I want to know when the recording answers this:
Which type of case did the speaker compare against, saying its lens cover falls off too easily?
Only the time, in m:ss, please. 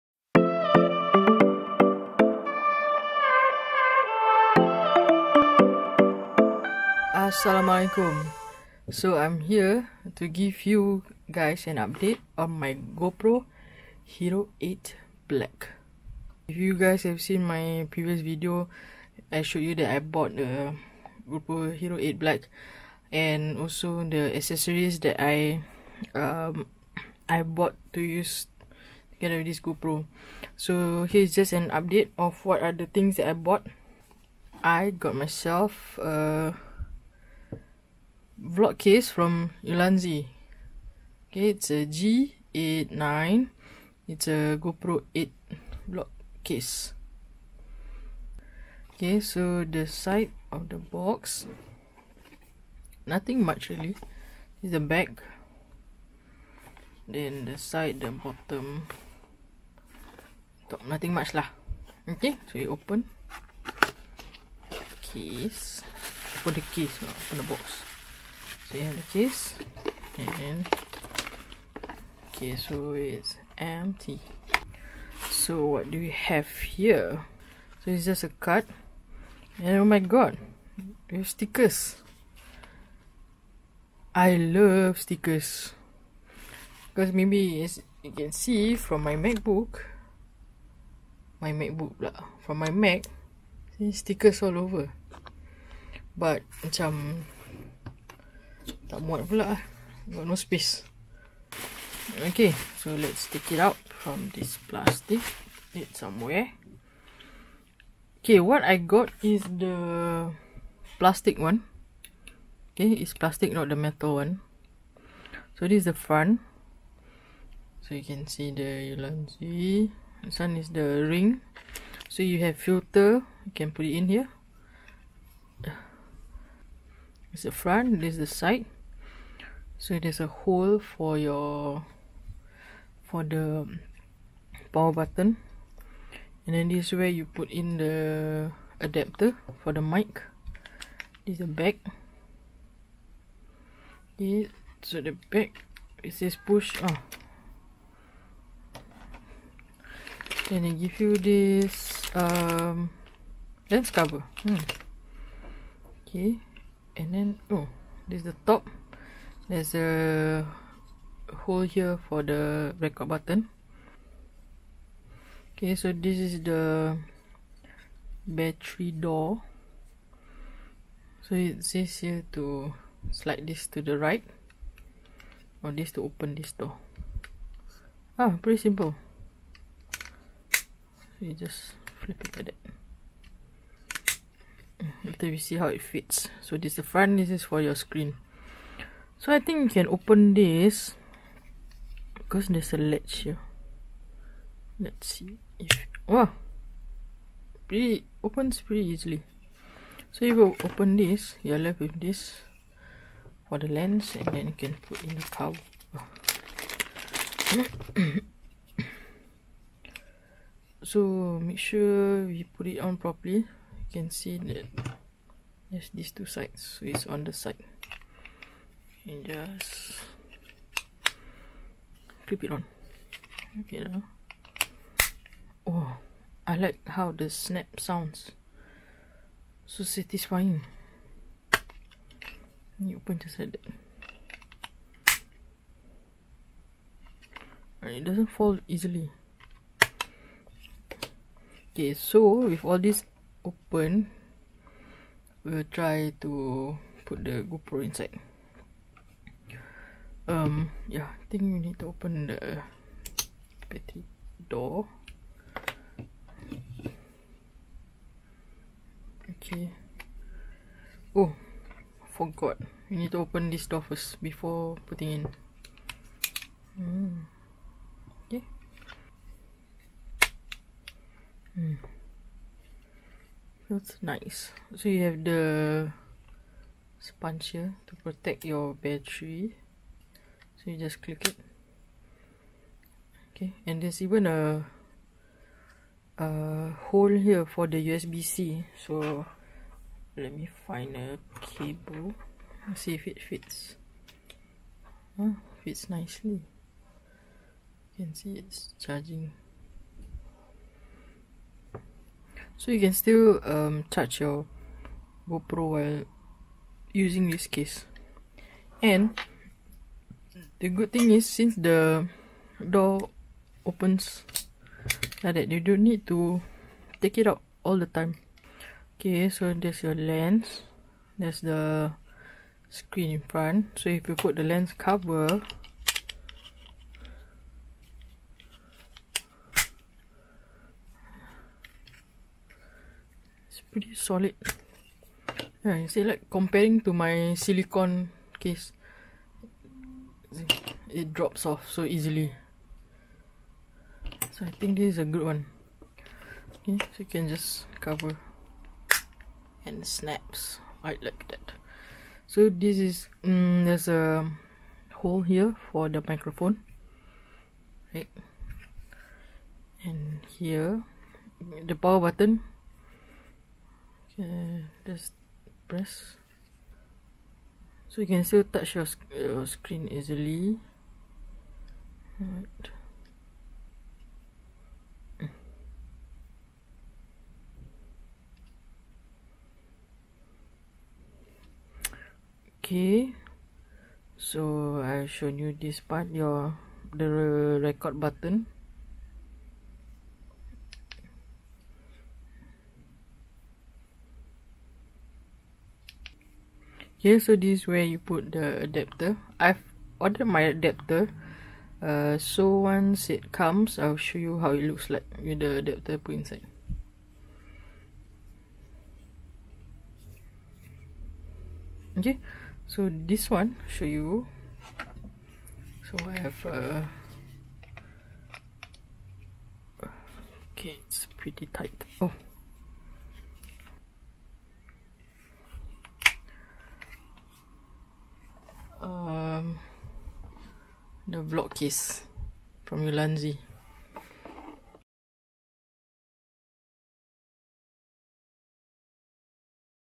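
5:37.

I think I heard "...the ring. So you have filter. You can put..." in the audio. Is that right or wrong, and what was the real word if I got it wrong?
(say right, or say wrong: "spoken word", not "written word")
right.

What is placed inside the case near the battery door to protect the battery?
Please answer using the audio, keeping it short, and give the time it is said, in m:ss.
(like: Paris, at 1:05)
Sponge, at 4:36.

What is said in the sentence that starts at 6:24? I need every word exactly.
So I show you this part your the record button.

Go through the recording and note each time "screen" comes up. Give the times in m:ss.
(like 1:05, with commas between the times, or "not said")
3:07, 5:22, 6:09.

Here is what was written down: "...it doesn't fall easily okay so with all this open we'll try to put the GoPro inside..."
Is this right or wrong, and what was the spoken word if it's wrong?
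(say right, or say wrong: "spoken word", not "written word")
right.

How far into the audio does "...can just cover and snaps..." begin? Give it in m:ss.
5:47.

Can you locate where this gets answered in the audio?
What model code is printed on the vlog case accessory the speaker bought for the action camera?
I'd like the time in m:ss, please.
0:41.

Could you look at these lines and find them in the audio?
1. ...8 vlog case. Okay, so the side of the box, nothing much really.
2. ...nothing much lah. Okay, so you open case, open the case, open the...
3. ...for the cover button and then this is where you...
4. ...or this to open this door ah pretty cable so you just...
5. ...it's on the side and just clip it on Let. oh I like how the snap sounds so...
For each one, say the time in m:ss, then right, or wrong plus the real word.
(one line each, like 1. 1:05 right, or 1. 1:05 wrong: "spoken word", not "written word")
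1. 0:45 right
2. 1:00 right
3. 2:13 wrong: "power", not "cover"
4. 2:55 wrong: "simple", not "cable"
5. 3:36 wrong: "Okay", not "Let".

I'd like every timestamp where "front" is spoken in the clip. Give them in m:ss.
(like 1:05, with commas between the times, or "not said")
1:55, 2:07, 3:06, 5:23.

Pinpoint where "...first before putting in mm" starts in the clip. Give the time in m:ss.
4:23.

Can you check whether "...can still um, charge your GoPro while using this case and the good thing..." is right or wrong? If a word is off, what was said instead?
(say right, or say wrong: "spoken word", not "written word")
right.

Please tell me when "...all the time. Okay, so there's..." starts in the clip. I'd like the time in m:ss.
5:17.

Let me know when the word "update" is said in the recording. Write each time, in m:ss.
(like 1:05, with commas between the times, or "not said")
0:11, 0:31.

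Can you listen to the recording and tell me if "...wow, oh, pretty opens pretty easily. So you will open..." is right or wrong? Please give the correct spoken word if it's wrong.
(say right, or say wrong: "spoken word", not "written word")
right.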